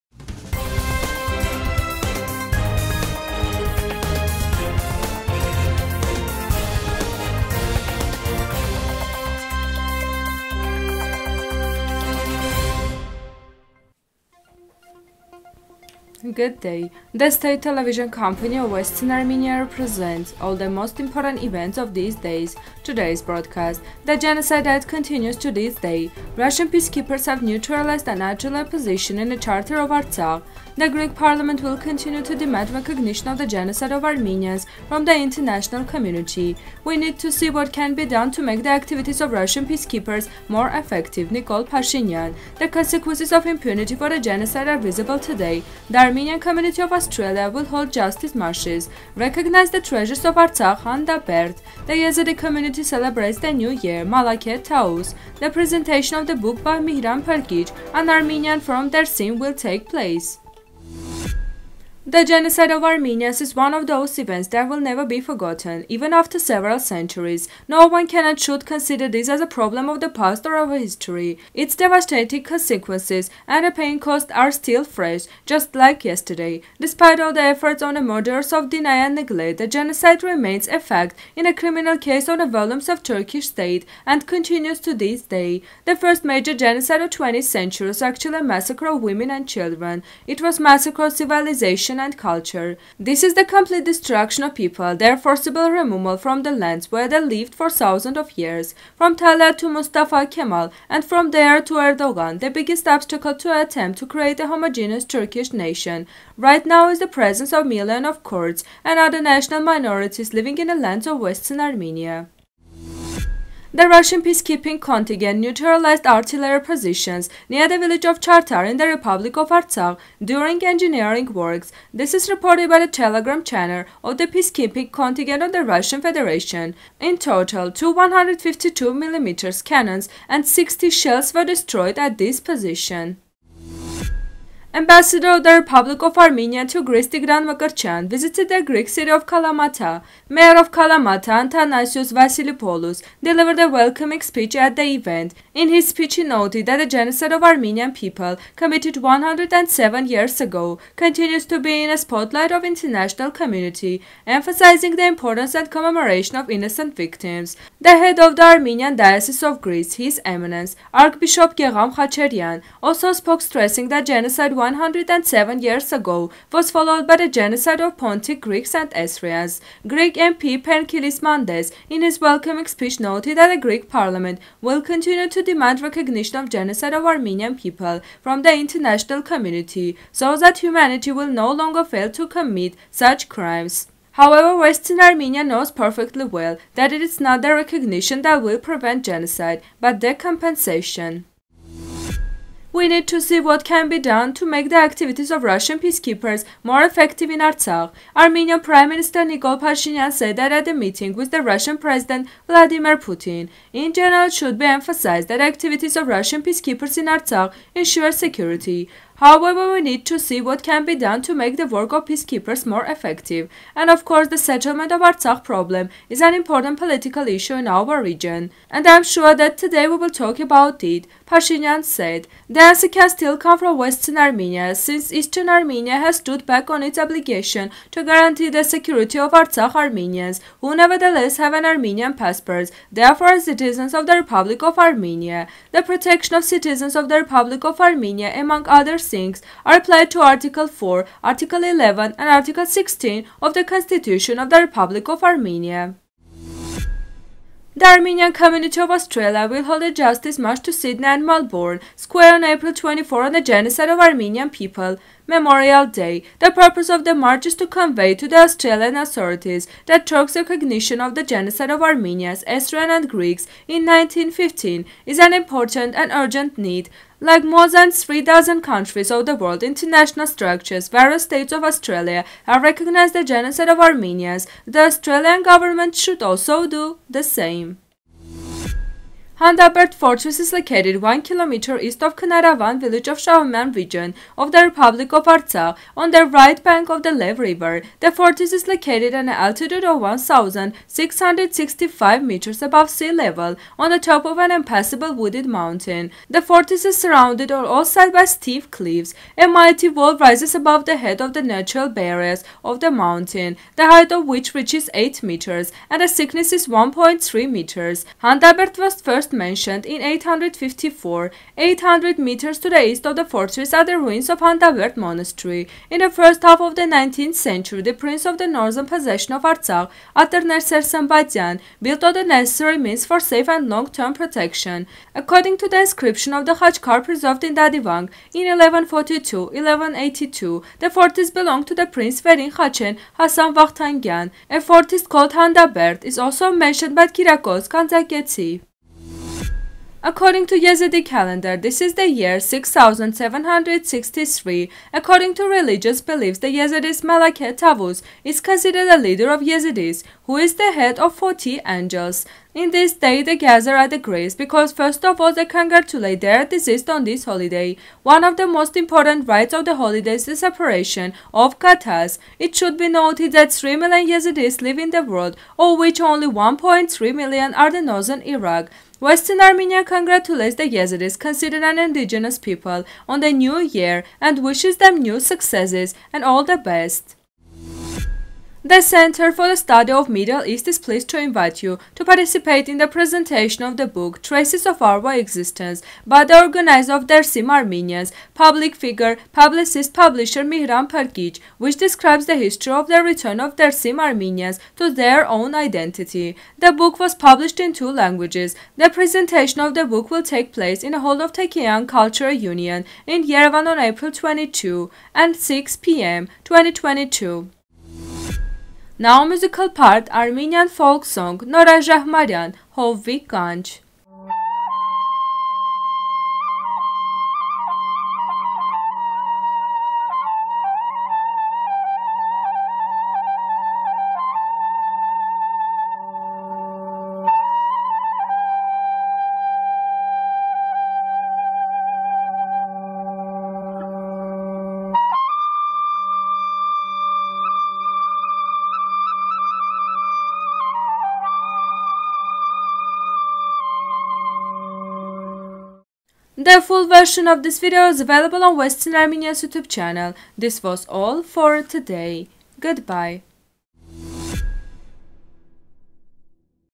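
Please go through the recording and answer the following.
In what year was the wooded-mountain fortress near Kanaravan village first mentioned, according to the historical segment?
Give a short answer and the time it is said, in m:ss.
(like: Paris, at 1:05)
854, at 5:10.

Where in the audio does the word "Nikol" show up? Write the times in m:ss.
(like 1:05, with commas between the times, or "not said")
0:41, 3:19.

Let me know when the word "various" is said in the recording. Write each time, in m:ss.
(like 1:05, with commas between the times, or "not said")
4:30.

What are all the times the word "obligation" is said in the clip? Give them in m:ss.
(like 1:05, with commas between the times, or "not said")
3:46.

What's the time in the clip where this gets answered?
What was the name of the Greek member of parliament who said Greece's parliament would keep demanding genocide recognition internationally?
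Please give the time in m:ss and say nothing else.
2:50.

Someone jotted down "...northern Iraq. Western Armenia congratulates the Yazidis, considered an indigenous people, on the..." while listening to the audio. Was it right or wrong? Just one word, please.
right.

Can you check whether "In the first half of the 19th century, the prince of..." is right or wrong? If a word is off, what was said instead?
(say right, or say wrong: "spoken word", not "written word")
right.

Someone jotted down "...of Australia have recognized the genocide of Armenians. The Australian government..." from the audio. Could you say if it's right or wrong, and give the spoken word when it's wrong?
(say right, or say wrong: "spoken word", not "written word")
right.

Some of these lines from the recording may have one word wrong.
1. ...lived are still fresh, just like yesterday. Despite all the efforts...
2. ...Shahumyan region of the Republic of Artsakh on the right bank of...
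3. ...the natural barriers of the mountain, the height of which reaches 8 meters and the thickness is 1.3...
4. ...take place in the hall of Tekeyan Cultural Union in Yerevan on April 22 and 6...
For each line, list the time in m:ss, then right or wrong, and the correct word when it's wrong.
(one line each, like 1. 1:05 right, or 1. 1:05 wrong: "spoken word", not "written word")
1. 1:13 wrong: "caused", not "lived"
2. 4:43 right
3. 5:01 right
4. 6:40 right.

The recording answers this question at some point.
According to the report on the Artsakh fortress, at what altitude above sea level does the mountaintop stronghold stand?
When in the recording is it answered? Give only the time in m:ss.
4:49.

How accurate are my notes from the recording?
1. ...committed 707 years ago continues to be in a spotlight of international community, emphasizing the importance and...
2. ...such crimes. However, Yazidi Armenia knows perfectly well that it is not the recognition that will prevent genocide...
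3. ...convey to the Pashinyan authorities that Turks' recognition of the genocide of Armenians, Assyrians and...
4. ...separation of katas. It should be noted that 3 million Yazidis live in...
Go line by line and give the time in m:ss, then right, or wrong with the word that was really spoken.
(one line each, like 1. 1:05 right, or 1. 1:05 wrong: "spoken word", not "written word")
1. 2:28 wrong: "107", not "707"
2. 3:02 wrong: "Western", not "Yazidi"
3. 4:17 wrong: "Australian", not "Pashinyan"
4. 6:00 right.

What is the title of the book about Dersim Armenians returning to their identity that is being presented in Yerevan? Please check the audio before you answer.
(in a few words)
Traces of Our Existence.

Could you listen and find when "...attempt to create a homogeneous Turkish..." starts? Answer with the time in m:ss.
1:43.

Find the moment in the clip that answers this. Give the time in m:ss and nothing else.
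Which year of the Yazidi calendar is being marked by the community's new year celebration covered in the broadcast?
5:42.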